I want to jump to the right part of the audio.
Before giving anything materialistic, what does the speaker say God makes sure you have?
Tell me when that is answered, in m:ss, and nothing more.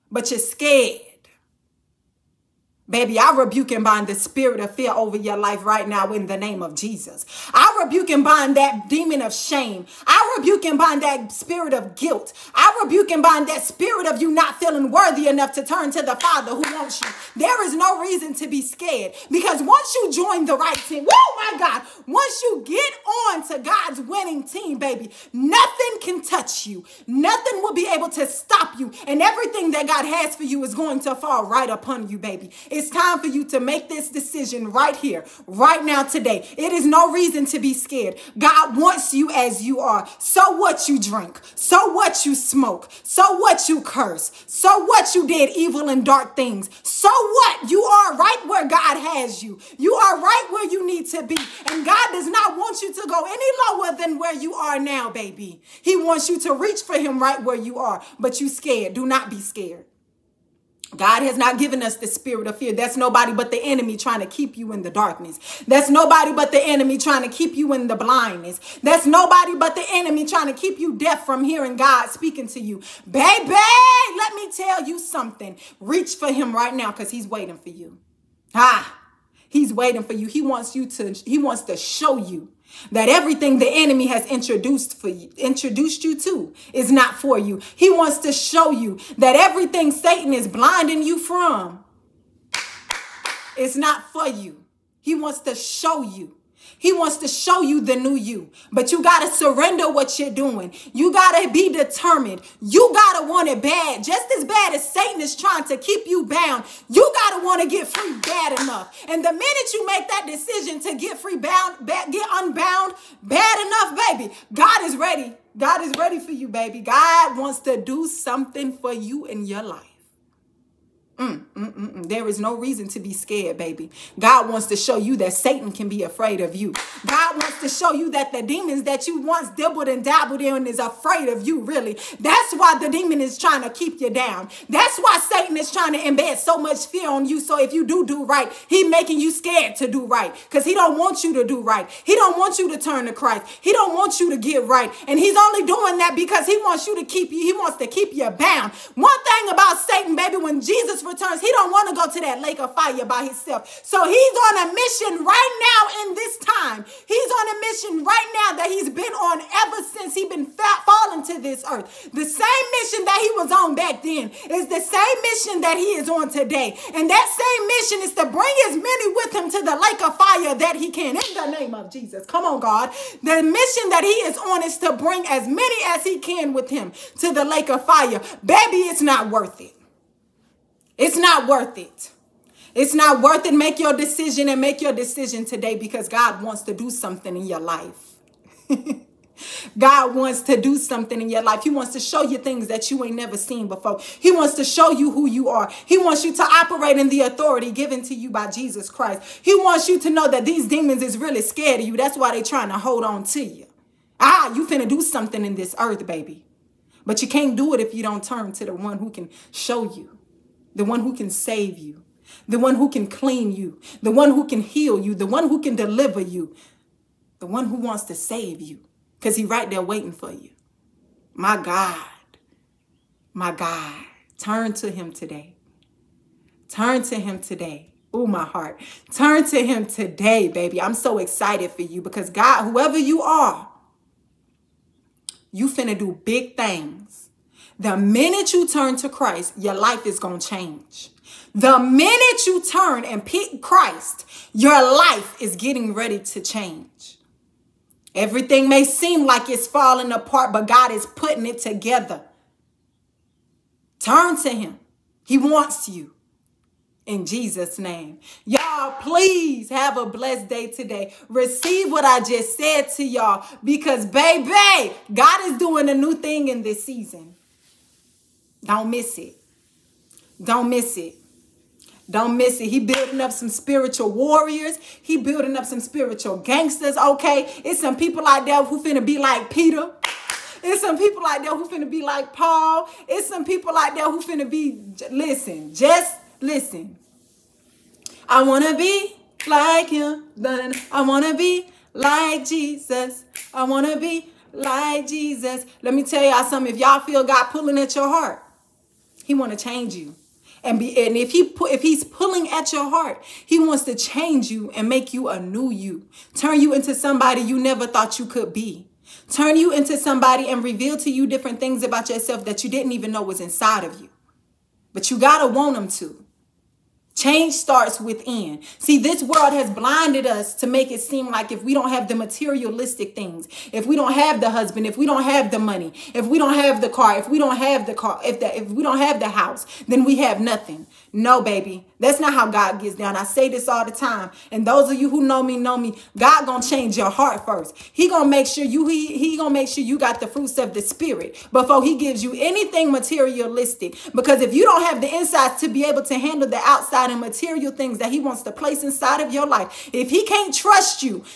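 5:40.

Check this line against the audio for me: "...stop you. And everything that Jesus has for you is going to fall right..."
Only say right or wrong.
wrong.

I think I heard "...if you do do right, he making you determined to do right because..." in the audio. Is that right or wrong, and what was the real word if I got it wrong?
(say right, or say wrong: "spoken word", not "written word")
wrong: "scared", not "determined".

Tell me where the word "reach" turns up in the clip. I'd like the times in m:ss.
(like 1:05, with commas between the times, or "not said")
0:56, 1:15.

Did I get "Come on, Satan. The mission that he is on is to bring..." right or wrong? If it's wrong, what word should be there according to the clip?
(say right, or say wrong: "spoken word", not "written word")
wrong: "God", not "Satan".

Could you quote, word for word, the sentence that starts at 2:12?
That's why the demon is trying to keep you down.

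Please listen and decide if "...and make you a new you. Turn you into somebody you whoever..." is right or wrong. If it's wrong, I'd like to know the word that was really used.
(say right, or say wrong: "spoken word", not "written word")
wrong: "never", not "whoever".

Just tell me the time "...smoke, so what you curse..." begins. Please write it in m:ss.
0:42.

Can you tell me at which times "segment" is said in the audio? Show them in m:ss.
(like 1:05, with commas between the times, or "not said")
not said.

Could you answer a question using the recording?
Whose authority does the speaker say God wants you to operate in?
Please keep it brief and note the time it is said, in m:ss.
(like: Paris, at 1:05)
Jesus Christ, at 3:18.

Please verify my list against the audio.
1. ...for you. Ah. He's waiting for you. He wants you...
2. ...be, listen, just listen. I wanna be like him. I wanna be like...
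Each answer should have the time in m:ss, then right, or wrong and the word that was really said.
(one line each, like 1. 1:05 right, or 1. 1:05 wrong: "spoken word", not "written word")
1. 1:17 right
2. 4:44 right.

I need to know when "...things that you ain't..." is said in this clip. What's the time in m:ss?
3:12.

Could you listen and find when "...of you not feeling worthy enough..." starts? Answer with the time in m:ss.
0:14.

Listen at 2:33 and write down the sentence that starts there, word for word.
So he's on a mission right now in this time.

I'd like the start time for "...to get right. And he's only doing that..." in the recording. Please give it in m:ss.
2:24.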